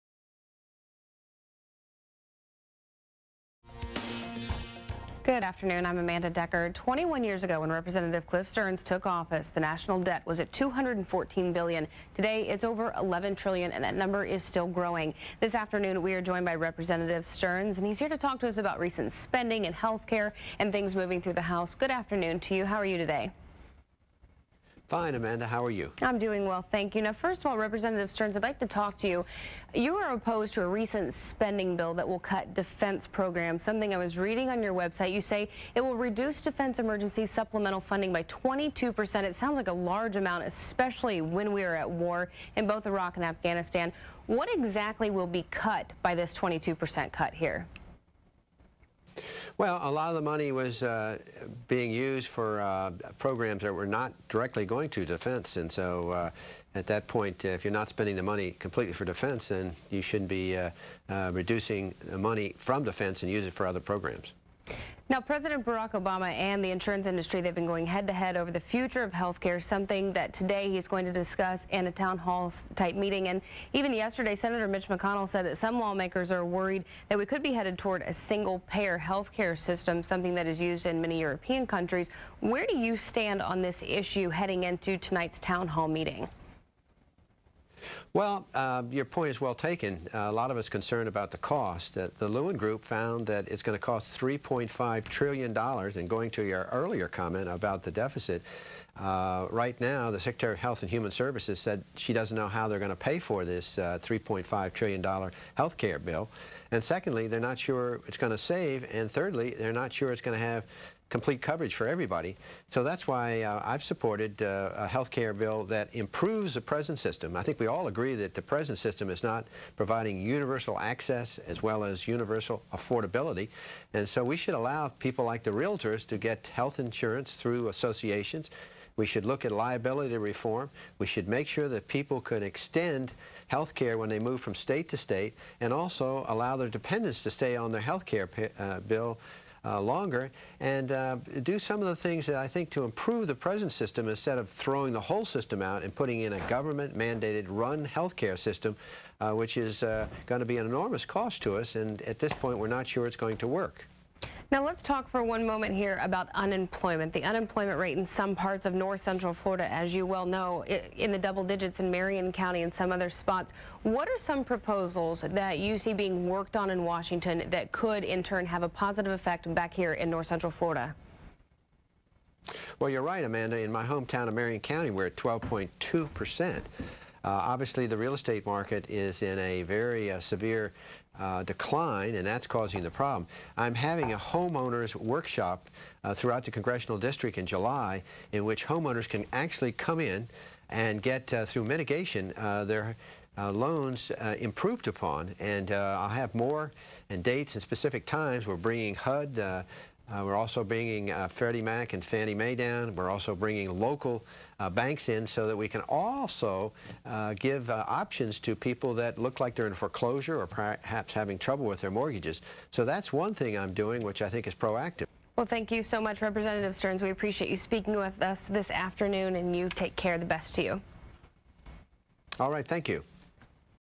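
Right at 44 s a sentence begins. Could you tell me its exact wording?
What exactly will be cut by this 22% cut here?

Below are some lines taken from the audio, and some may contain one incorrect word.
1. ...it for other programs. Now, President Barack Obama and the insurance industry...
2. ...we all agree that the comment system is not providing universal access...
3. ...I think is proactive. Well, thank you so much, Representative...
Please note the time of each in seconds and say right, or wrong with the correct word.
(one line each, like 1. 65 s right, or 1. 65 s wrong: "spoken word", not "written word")
1. 63 s right
2. 117 s wrong: "present", not "comment"
3. 214 s right.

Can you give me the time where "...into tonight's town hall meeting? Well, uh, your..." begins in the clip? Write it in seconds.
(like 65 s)
84 s.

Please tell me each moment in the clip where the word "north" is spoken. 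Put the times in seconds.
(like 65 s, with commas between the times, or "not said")
158 s, 170 s.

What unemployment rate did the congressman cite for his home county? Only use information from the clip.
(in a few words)
12.2 percent.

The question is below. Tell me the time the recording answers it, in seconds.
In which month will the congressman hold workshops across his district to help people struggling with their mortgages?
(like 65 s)
187 s.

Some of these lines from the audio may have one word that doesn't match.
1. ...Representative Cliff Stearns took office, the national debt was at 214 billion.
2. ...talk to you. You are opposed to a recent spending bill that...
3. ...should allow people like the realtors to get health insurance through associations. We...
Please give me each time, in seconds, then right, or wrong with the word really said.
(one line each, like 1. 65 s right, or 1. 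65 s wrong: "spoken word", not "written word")
1. 7 s right
2. 28 s right
3. 124 s right.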